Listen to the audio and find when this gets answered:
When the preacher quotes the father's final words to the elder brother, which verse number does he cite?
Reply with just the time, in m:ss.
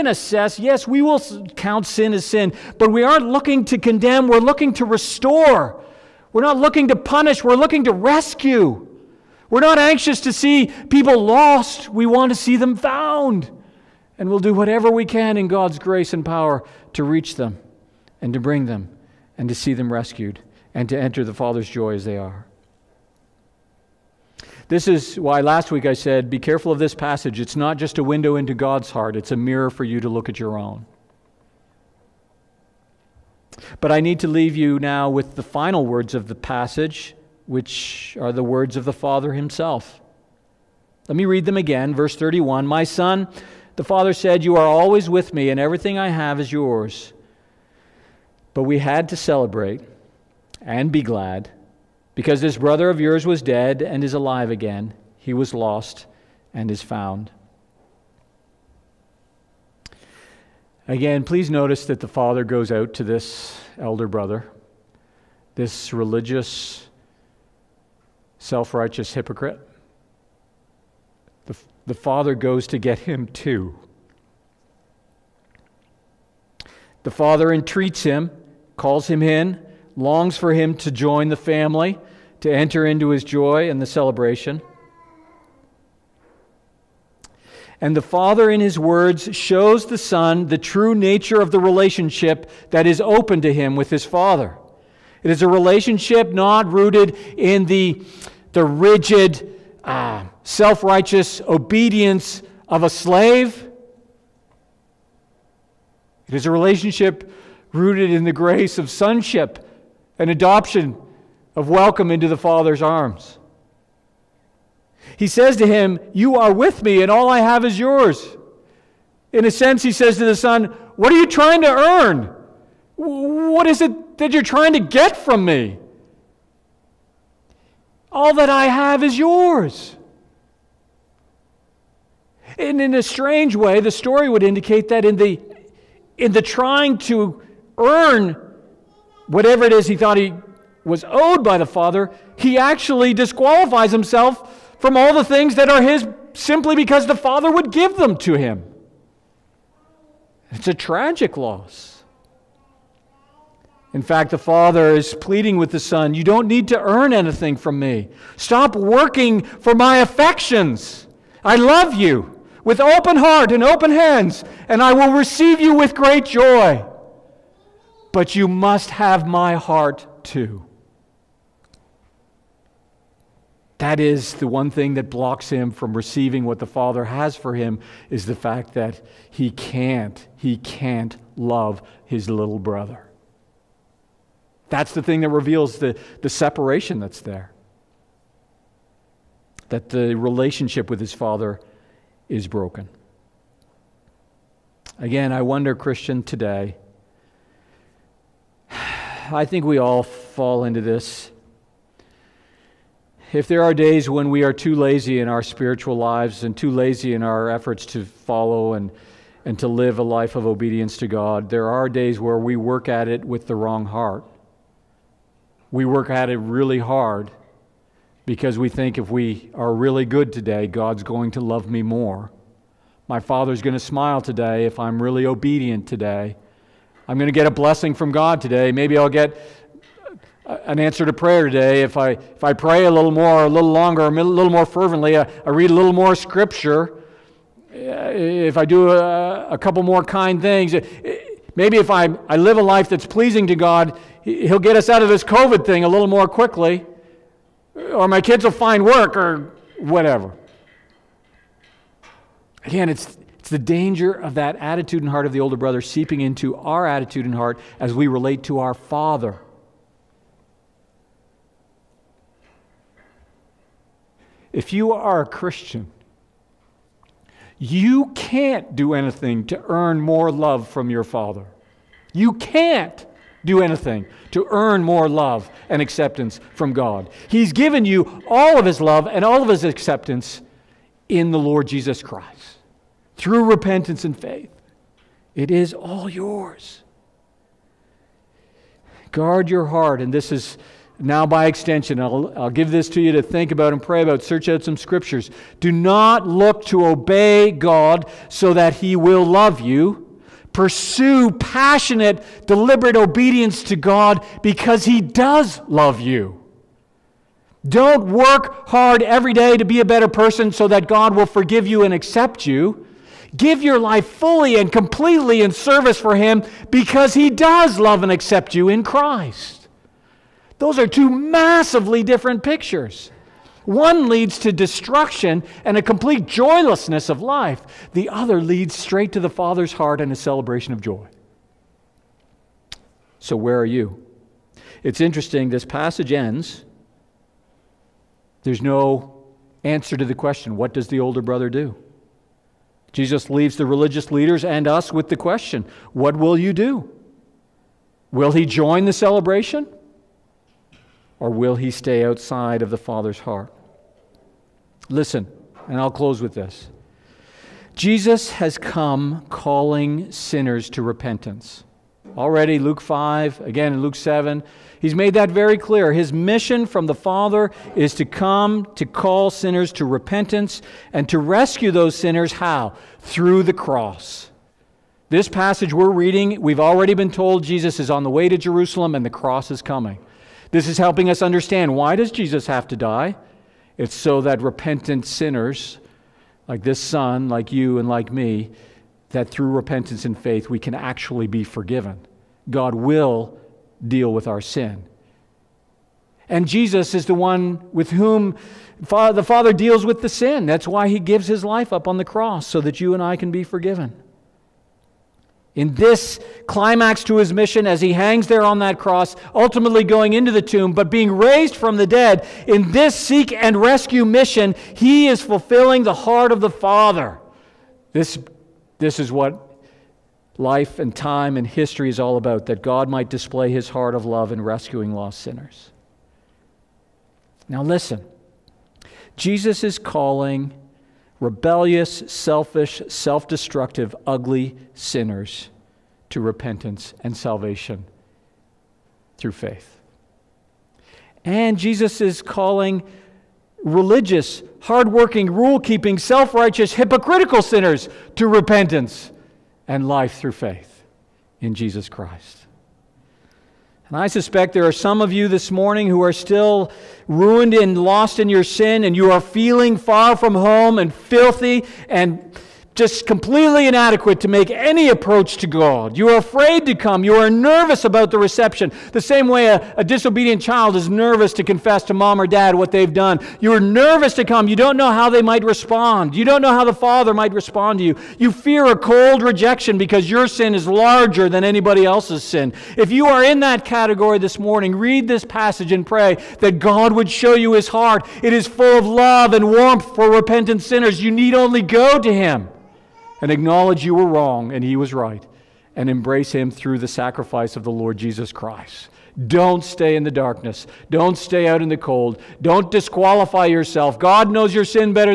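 0:41.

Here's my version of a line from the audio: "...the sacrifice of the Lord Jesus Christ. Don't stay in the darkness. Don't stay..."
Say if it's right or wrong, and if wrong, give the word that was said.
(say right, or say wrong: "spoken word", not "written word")
right.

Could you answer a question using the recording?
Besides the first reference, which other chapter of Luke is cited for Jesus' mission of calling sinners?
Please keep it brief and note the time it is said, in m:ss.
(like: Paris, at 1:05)
Luke 7, at 6:03.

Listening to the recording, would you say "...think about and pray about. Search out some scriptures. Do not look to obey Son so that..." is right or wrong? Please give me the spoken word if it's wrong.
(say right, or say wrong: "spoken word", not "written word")
wrong: "God", not "Son".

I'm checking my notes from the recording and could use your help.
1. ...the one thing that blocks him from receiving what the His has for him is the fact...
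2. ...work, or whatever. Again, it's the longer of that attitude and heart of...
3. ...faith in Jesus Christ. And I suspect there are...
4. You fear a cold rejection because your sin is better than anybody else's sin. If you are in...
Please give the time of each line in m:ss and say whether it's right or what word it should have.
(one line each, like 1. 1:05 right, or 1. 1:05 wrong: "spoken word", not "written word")
1. 2:54 wrong: "Father", not "His"
2. 4:08 wrong: "danger", not "longer"
3. 7:30 right
4. 7:58 wrong: "larger", not "better".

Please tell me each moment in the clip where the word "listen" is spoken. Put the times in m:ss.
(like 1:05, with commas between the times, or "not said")
5:54, 7:07.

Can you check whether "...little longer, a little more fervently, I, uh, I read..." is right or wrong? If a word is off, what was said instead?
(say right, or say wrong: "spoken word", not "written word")
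right.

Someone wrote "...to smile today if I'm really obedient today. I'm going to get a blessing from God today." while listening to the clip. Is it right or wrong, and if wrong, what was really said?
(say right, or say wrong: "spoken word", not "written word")
right.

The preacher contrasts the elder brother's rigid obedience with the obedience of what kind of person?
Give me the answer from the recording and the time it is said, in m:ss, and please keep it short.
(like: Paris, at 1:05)
a slave, at 1:42.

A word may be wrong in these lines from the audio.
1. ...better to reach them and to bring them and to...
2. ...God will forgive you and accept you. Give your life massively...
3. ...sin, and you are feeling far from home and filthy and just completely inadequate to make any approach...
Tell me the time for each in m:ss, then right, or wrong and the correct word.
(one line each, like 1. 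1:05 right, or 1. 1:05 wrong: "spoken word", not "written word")
1. 0:16 wrong: "power", not "better"
2. 5:10 wrong: "fully", not "massively"
3. 7:38 right.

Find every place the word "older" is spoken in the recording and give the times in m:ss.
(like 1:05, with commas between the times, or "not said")
4:15, 5:41.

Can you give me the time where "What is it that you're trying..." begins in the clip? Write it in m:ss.
2:02.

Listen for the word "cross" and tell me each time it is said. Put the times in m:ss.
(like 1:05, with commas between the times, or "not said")
6:13, 6:19, 6:42, 6:48.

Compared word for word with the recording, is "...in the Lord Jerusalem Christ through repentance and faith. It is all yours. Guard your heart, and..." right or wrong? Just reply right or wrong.
wrong.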